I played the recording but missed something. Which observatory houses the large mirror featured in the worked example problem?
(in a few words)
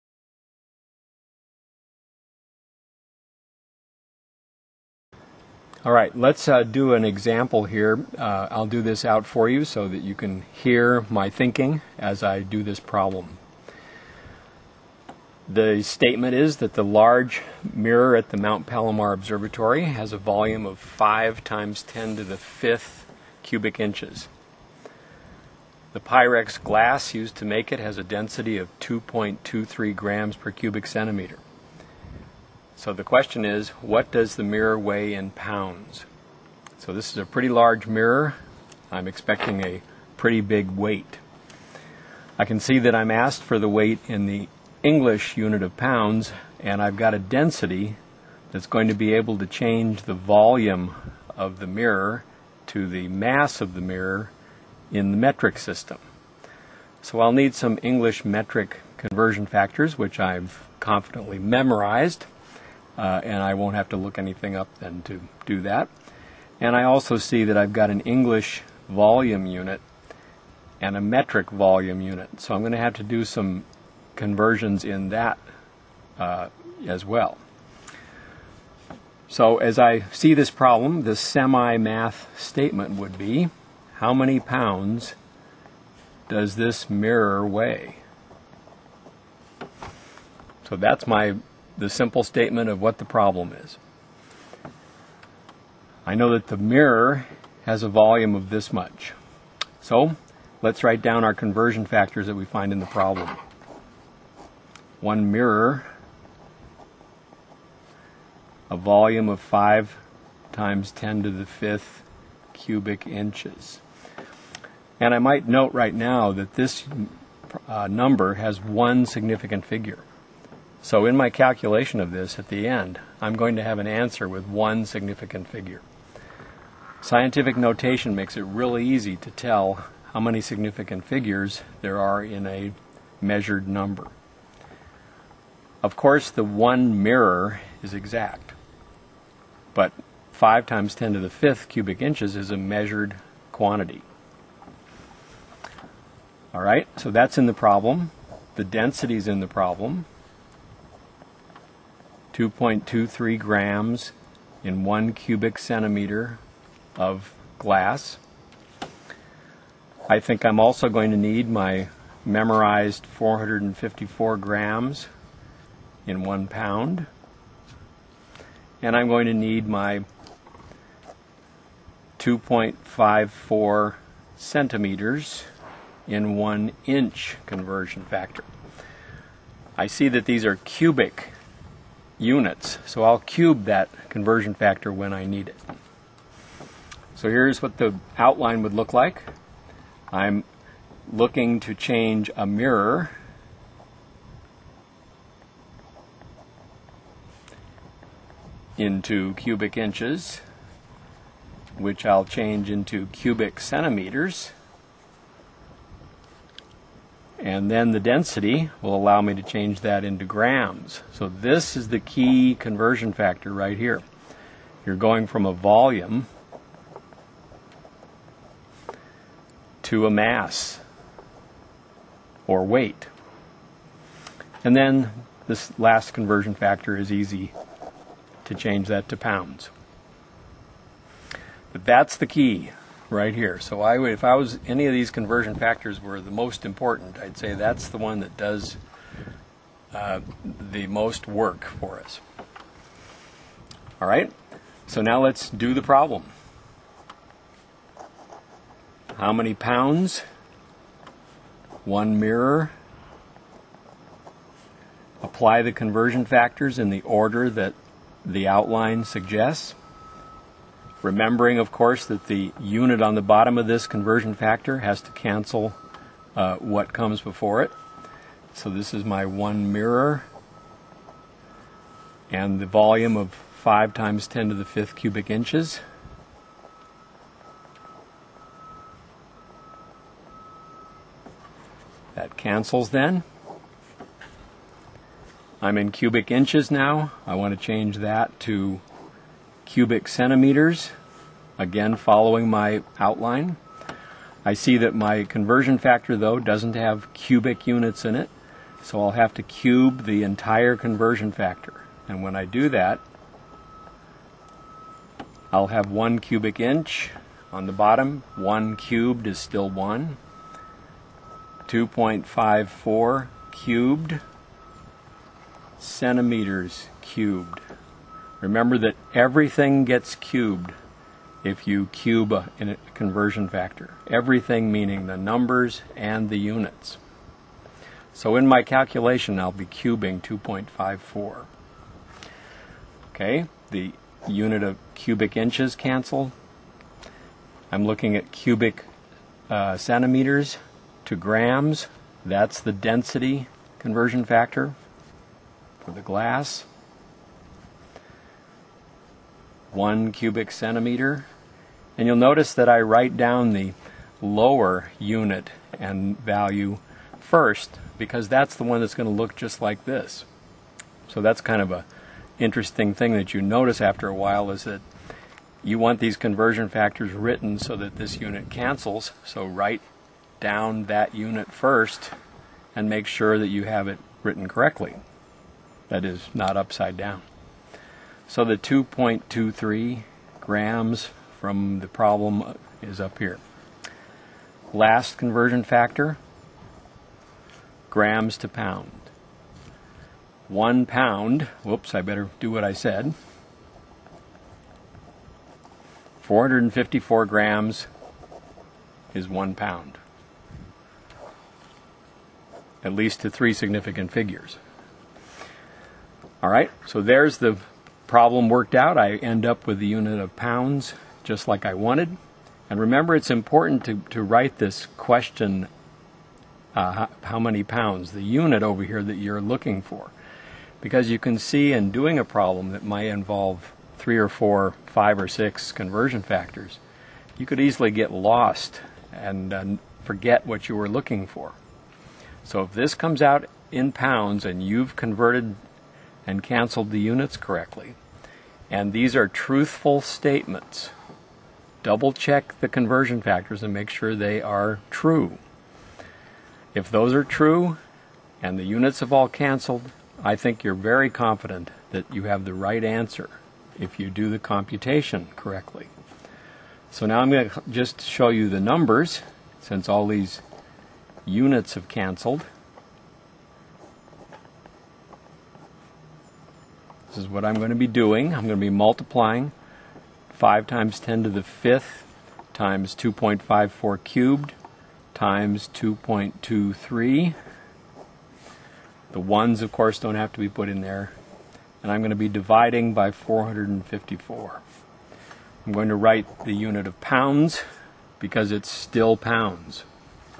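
Mount Palomar.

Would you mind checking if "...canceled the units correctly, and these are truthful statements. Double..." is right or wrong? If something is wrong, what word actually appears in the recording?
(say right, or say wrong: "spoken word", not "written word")
right.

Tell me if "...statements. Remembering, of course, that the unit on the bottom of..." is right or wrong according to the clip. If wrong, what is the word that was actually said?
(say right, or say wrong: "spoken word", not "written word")
wrong: "suggests", not "statements".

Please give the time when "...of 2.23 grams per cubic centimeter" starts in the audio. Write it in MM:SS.
00:28.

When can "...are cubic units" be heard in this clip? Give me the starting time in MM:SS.
03:00.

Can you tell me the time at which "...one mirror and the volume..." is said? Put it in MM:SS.
04:29.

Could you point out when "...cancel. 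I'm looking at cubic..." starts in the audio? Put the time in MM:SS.
05:35.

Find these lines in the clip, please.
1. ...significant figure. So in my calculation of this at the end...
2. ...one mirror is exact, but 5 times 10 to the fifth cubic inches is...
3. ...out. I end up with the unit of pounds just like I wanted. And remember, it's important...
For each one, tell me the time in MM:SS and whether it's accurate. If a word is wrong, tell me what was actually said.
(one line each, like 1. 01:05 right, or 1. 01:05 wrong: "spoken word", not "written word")
1. 01:59 right
2. 02:16 right
3. 06:48 right.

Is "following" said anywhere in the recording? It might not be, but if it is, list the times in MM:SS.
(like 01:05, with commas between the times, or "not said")
04:51.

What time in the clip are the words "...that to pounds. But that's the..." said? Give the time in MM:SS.
03:48.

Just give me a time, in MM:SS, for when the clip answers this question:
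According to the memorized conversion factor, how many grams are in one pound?
02:43.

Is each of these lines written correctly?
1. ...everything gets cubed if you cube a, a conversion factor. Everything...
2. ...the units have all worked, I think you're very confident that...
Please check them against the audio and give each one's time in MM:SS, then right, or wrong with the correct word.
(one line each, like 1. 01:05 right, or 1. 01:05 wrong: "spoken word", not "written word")
1. 05:19 right
2. 07:28 wrong: "canceled", not "worked".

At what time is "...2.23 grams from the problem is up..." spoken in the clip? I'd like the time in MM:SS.
06:18.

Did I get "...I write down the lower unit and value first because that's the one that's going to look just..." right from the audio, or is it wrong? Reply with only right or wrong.
right.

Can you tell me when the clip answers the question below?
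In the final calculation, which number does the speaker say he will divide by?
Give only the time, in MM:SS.
08:02.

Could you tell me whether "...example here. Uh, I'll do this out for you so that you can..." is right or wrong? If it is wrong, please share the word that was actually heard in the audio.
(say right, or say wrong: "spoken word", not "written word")
right.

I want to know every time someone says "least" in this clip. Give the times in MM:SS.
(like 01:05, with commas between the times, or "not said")
06:42.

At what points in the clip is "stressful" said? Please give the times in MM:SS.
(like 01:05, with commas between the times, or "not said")
not said.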